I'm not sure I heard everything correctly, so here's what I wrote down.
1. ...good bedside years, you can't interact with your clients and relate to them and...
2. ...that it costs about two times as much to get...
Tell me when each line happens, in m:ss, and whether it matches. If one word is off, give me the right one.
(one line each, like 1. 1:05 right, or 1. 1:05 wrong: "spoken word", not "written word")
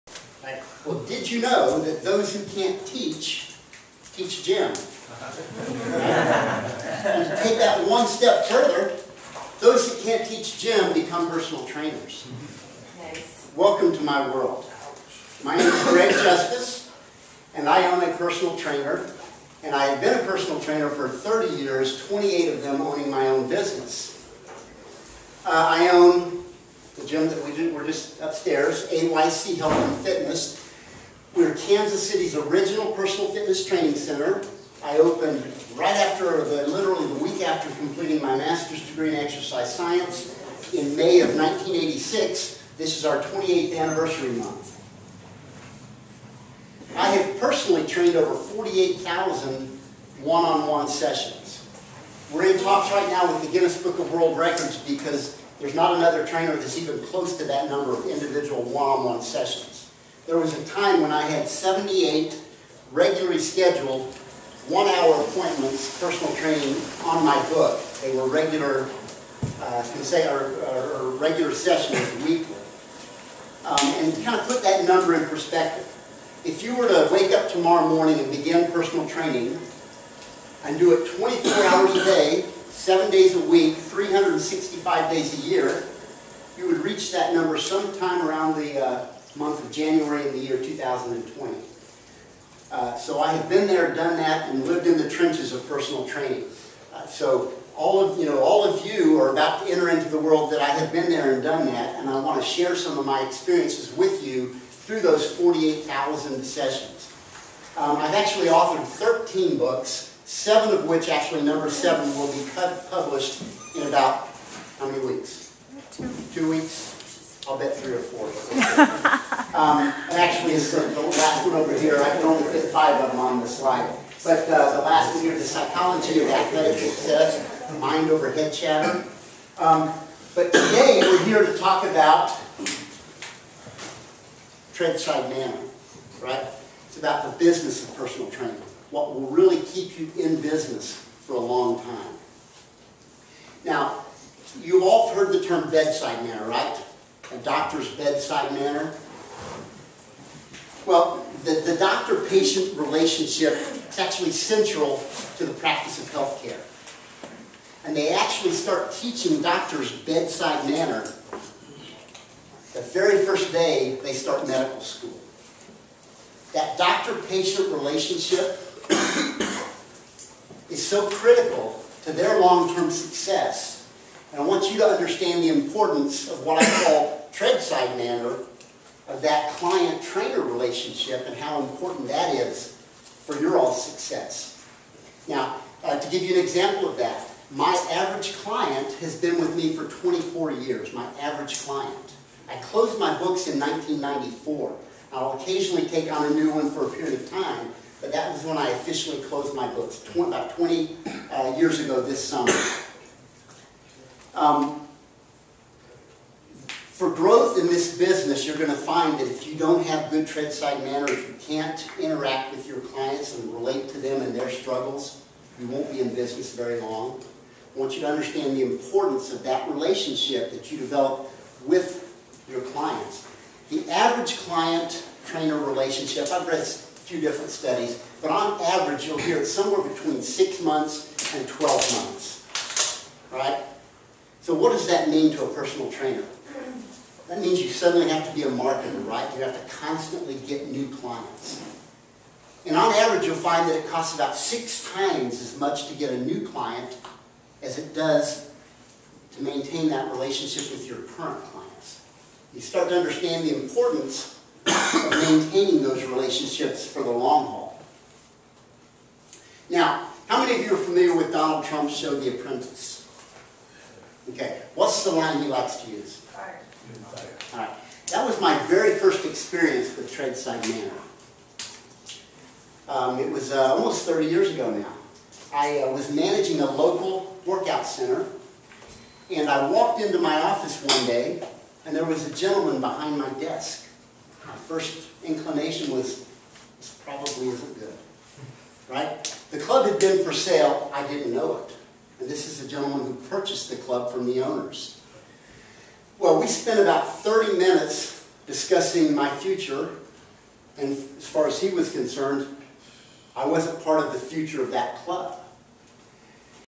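1. 3:30 wrong: "manners", not "years"
2. 4:03 wrong: "six", not "two".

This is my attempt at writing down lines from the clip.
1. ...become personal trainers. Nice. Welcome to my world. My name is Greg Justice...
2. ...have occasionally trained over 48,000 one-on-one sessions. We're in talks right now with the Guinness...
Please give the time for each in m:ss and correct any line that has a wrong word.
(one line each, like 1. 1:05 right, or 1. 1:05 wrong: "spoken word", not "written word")
1. 0:10 right
2. 0:47 wrong: "personally", not "occasionally".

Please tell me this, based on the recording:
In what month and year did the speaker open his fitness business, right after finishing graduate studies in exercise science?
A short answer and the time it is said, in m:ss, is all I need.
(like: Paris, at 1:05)
May 1986, at 0:40.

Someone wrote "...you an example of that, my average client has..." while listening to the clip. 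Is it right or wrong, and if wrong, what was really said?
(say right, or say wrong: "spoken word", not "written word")
right.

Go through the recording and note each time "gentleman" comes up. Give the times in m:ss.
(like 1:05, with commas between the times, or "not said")
4:42, 4:52.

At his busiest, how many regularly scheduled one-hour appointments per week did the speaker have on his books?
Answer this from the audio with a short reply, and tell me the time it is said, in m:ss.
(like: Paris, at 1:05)
78, at 1:01.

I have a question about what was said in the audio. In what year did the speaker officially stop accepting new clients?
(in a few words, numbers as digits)
1994.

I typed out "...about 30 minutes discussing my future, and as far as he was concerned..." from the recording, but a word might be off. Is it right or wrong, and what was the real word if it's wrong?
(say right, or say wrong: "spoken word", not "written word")
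right.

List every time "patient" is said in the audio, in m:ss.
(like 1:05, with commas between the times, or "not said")
2:31, 2:46.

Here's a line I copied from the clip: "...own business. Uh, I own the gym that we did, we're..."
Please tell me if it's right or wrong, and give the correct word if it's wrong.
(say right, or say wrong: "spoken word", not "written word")
right.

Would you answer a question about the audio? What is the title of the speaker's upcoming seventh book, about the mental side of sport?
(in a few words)
The Psychology of Athletic Success.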